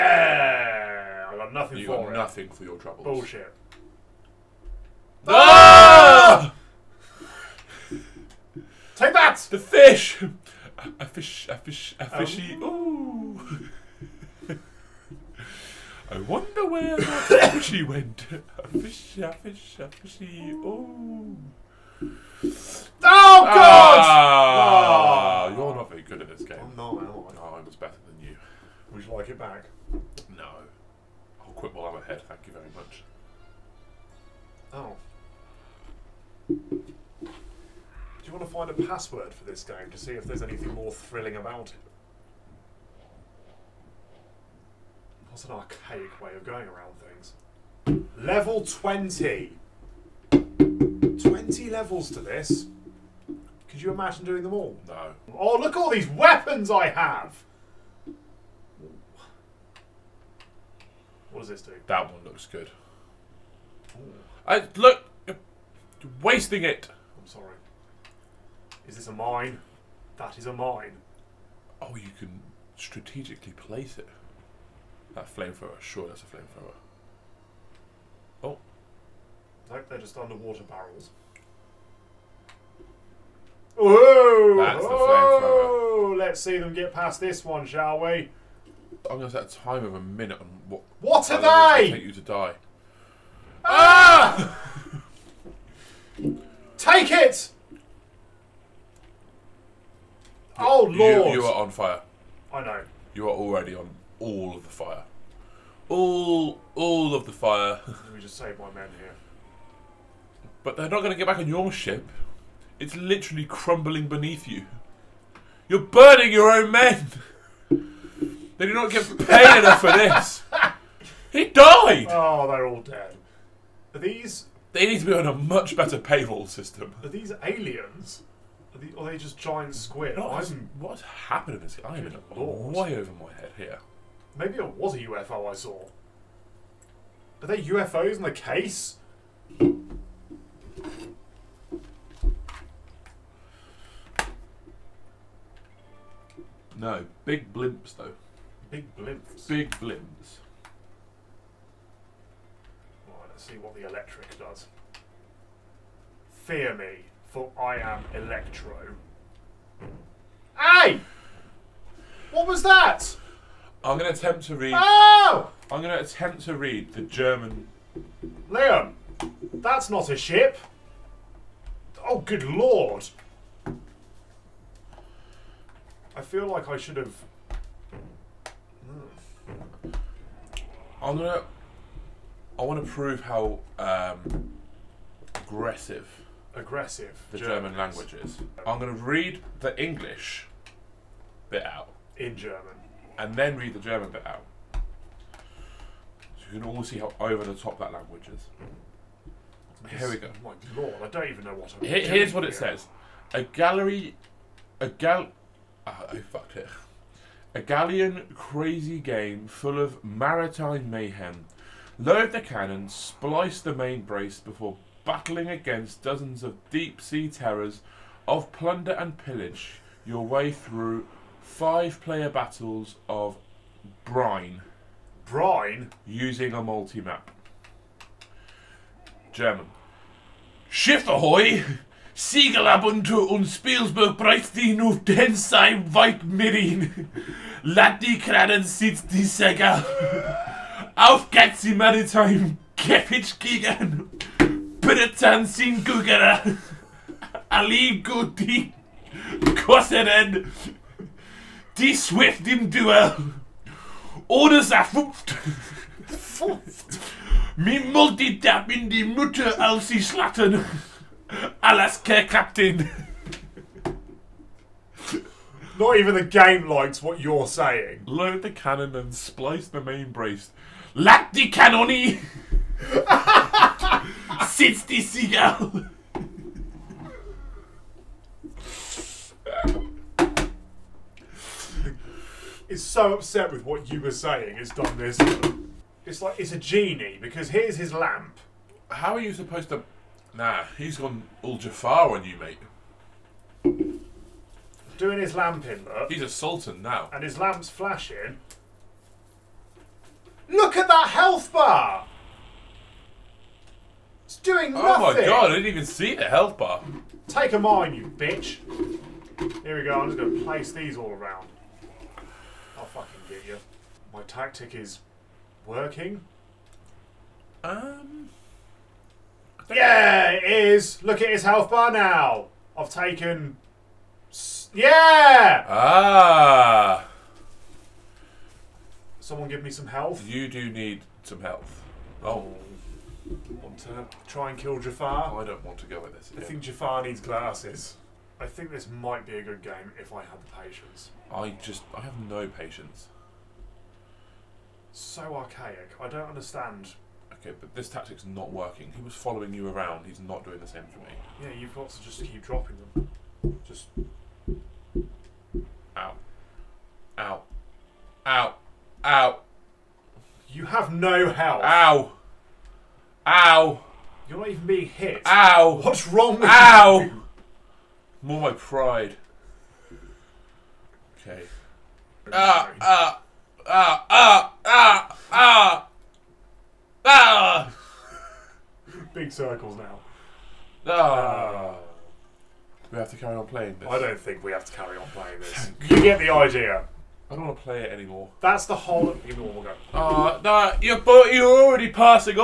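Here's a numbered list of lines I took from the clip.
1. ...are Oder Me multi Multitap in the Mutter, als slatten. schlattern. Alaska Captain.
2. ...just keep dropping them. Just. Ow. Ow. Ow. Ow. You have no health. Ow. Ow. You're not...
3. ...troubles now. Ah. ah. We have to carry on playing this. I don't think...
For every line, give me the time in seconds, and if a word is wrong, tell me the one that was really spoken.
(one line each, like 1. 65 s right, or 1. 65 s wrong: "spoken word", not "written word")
1. 252 s right
2. 352 s right
3. 379 s wrong: "circles", not "troubles".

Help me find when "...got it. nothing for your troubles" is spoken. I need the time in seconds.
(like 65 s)
2 s.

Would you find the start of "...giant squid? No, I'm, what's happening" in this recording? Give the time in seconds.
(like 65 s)
129 s.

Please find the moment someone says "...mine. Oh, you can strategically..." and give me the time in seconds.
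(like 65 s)
70 s.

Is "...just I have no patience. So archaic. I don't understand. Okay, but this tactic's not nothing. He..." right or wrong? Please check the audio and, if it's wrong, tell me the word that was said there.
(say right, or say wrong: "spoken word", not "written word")
wrong: "working", not "nothing".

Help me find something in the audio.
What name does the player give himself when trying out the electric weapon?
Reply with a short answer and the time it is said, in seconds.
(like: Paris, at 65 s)
Electro, at 158 s.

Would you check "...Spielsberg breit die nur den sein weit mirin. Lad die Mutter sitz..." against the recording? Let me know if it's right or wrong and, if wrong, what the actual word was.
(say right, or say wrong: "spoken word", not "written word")
wrong: "Kranen", not "Mutter".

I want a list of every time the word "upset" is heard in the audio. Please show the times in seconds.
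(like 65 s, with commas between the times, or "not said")
283 s.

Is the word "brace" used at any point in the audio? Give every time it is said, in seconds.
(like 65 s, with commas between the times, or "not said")
214 s, 270 s.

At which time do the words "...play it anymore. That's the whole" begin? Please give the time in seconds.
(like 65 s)
387 s.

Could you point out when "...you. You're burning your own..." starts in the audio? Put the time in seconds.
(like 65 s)
114 s.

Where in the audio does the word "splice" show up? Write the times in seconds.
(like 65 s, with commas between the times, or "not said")
212 s, 269 s.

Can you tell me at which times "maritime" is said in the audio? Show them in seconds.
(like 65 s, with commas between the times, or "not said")
210 s, 241 s.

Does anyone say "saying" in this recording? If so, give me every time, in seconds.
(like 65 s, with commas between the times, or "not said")
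267 s, 284 s.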